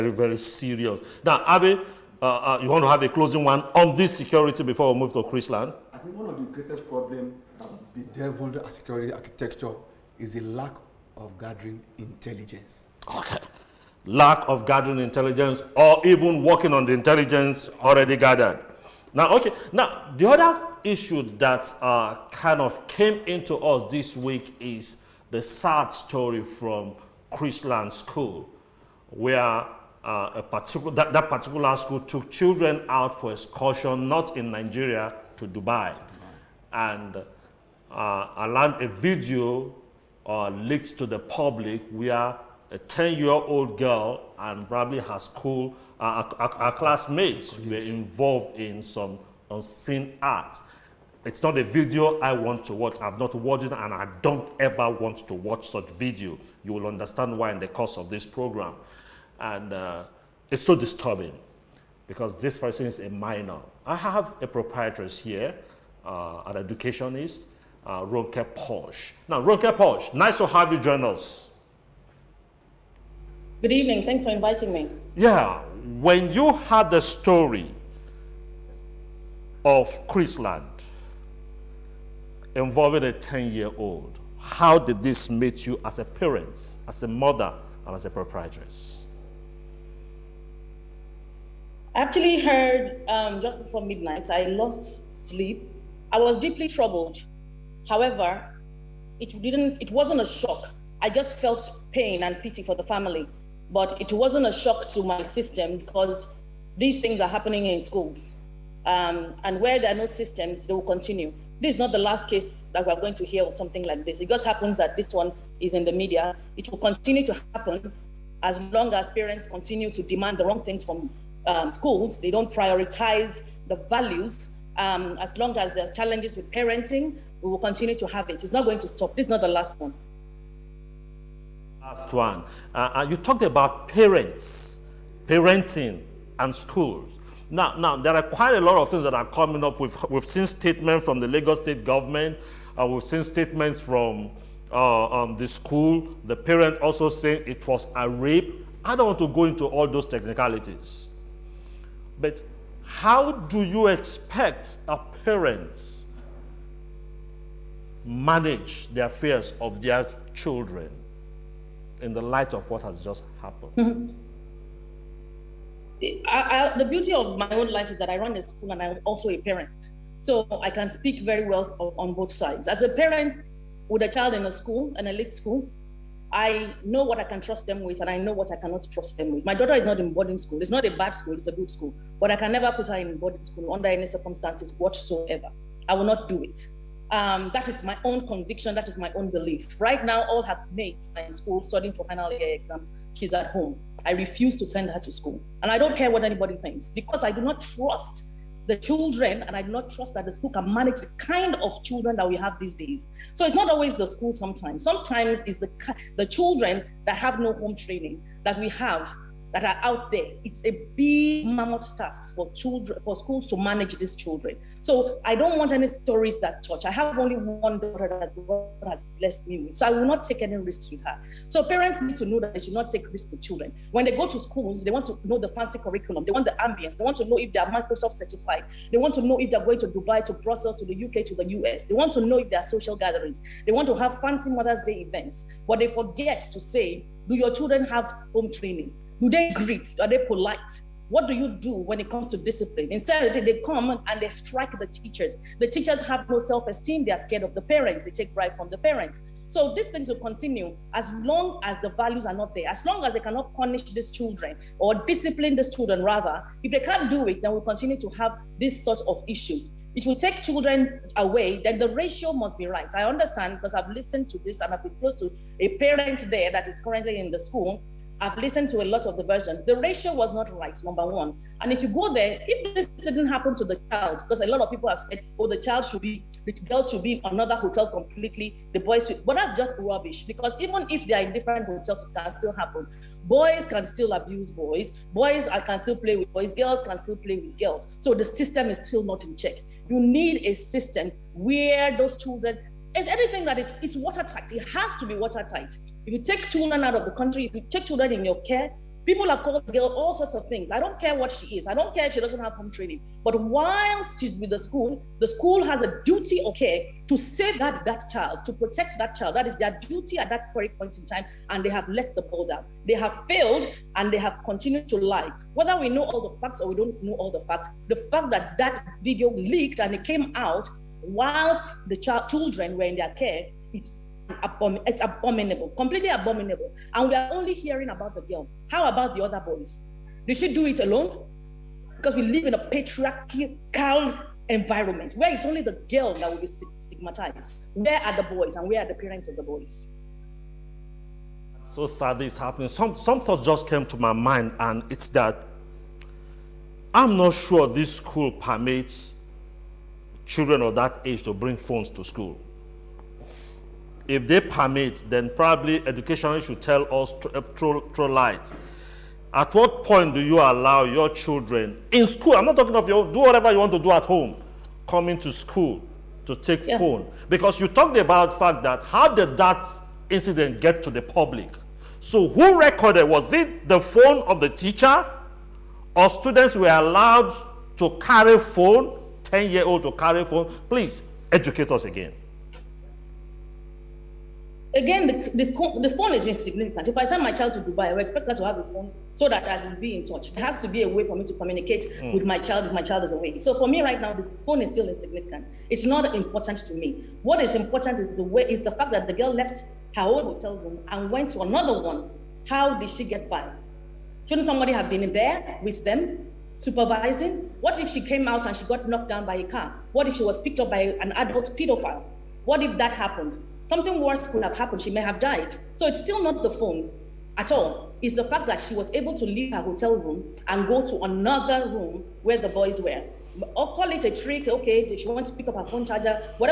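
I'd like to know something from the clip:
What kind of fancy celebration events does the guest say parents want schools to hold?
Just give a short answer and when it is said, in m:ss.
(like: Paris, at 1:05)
Mother's Day events, at 3:54.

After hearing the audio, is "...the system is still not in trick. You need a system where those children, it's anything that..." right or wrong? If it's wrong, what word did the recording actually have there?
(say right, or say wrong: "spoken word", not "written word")
wrong: "check", not "trick".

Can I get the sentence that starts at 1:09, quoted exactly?
Now, Ronke Posh, nice to have you join us.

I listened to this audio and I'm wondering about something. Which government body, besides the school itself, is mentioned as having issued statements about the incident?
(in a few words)
Lagos state government.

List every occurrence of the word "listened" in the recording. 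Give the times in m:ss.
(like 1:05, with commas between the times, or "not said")
4:23, 4:28.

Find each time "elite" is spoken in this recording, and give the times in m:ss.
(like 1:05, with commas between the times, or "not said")
2:55.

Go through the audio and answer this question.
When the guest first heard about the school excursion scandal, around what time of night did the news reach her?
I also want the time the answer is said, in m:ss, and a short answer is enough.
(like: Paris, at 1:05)
Just before midnight, at 1:33.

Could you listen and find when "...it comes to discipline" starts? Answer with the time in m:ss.
4:01.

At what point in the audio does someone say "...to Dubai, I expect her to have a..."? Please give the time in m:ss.
6:27.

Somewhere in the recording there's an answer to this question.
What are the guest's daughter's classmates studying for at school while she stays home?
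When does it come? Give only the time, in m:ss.
3:12.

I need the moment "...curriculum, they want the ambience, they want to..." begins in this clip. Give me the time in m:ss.
3:45.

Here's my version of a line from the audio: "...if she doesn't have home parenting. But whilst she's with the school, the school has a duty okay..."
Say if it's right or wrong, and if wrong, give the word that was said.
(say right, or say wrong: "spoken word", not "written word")
wrong: "training", not "parenting".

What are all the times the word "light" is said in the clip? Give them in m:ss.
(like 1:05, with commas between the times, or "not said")
2:42, 5:58.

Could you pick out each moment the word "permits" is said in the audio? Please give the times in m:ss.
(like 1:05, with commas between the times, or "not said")
5:48, 5:54.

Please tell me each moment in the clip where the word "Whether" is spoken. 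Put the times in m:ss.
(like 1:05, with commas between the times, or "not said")
5:15.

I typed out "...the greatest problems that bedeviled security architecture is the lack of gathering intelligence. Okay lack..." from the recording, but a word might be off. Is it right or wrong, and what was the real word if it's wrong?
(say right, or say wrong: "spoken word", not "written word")
right.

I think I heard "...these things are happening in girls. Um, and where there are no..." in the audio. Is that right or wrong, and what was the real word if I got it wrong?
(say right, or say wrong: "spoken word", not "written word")
wrong: "schools", not "girls".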